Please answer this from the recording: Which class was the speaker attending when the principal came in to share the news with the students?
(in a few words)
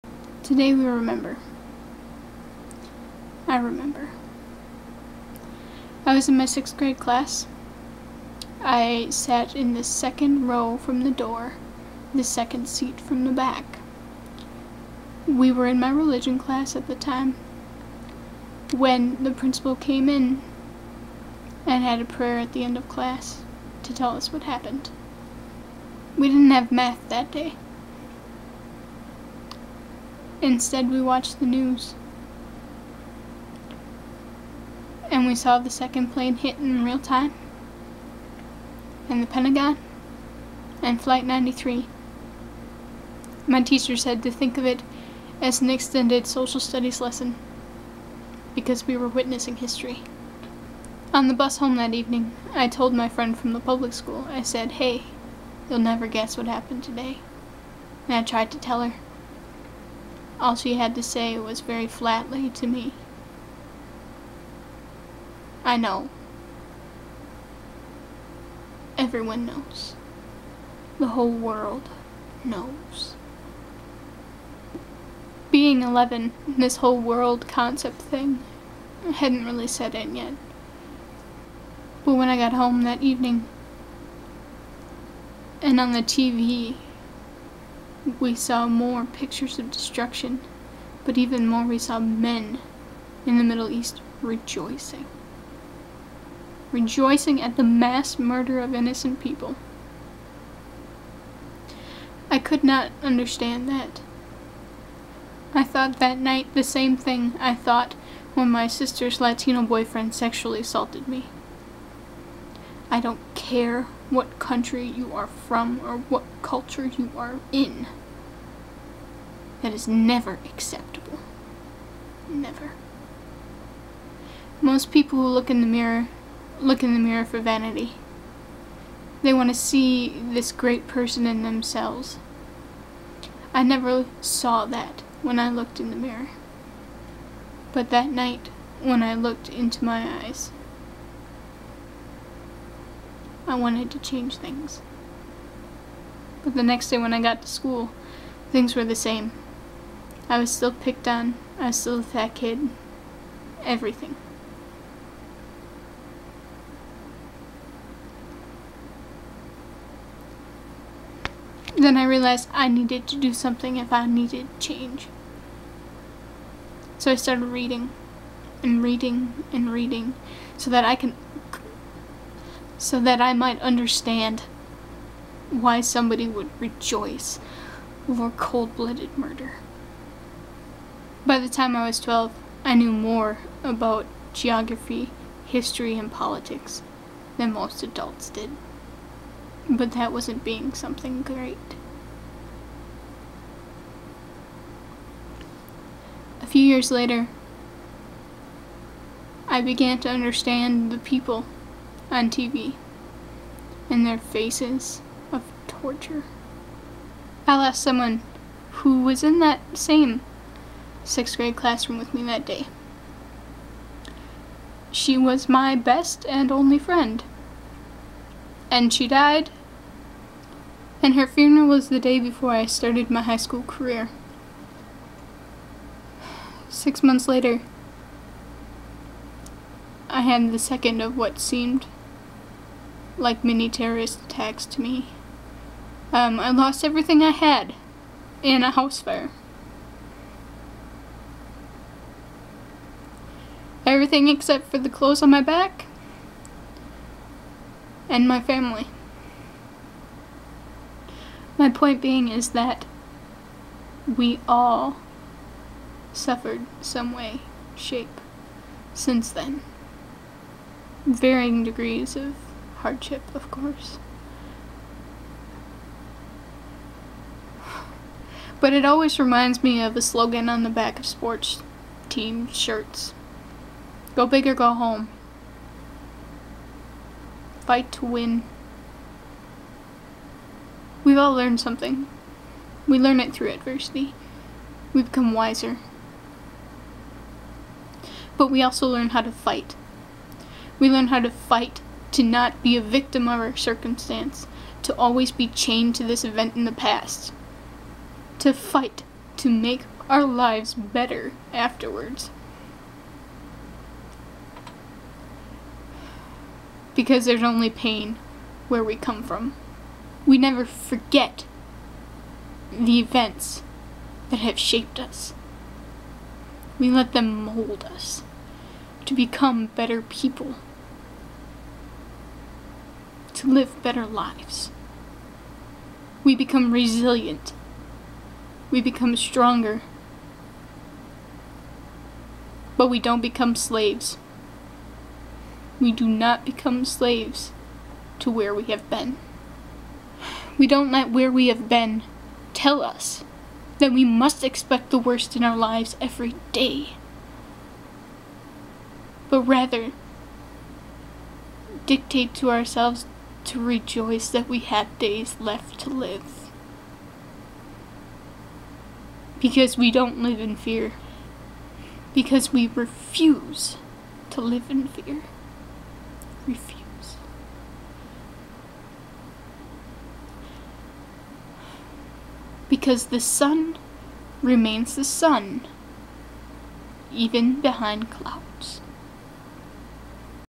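religion class.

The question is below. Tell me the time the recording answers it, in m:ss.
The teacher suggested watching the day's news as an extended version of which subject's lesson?
0:46.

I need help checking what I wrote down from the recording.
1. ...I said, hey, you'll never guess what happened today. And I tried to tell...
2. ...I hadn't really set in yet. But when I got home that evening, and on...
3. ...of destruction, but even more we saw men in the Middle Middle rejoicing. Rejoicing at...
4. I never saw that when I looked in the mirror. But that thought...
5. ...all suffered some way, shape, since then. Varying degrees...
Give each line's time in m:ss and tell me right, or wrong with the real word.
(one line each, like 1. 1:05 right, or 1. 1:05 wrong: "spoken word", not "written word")
1. 0:54 right
2. 1:19 right
3. 1:29 wrong: "East", not "Middle"
4. 2:13 wrong: "night", not "thought"
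5. 4:14 right.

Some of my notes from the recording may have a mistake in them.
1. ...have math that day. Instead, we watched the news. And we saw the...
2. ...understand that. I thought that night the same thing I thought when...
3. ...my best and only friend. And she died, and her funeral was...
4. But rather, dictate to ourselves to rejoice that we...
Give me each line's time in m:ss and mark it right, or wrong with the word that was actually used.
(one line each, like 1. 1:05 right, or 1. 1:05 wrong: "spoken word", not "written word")
1. 0:26 right
2. 1:43 right
3. 3:35 right
4. 5:49 right.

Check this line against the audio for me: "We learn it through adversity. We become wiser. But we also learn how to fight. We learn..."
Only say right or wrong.
right.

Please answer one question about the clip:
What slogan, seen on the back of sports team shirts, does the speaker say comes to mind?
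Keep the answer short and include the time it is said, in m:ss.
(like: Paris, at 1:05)
Go big or go home, at 4:34.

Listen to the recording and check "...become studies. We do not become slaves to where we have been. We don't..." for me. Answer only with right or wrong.
wrong.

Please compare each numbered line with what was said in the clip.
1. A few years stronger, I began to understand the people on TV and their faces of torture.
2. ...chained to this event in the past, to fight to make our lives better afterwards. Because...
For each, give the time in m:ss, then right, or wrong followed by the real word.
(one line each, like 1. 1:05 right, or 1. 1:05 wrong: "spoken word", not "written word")
1. 3:16 wrong: "later", not "stronger"
2. 4:55 right.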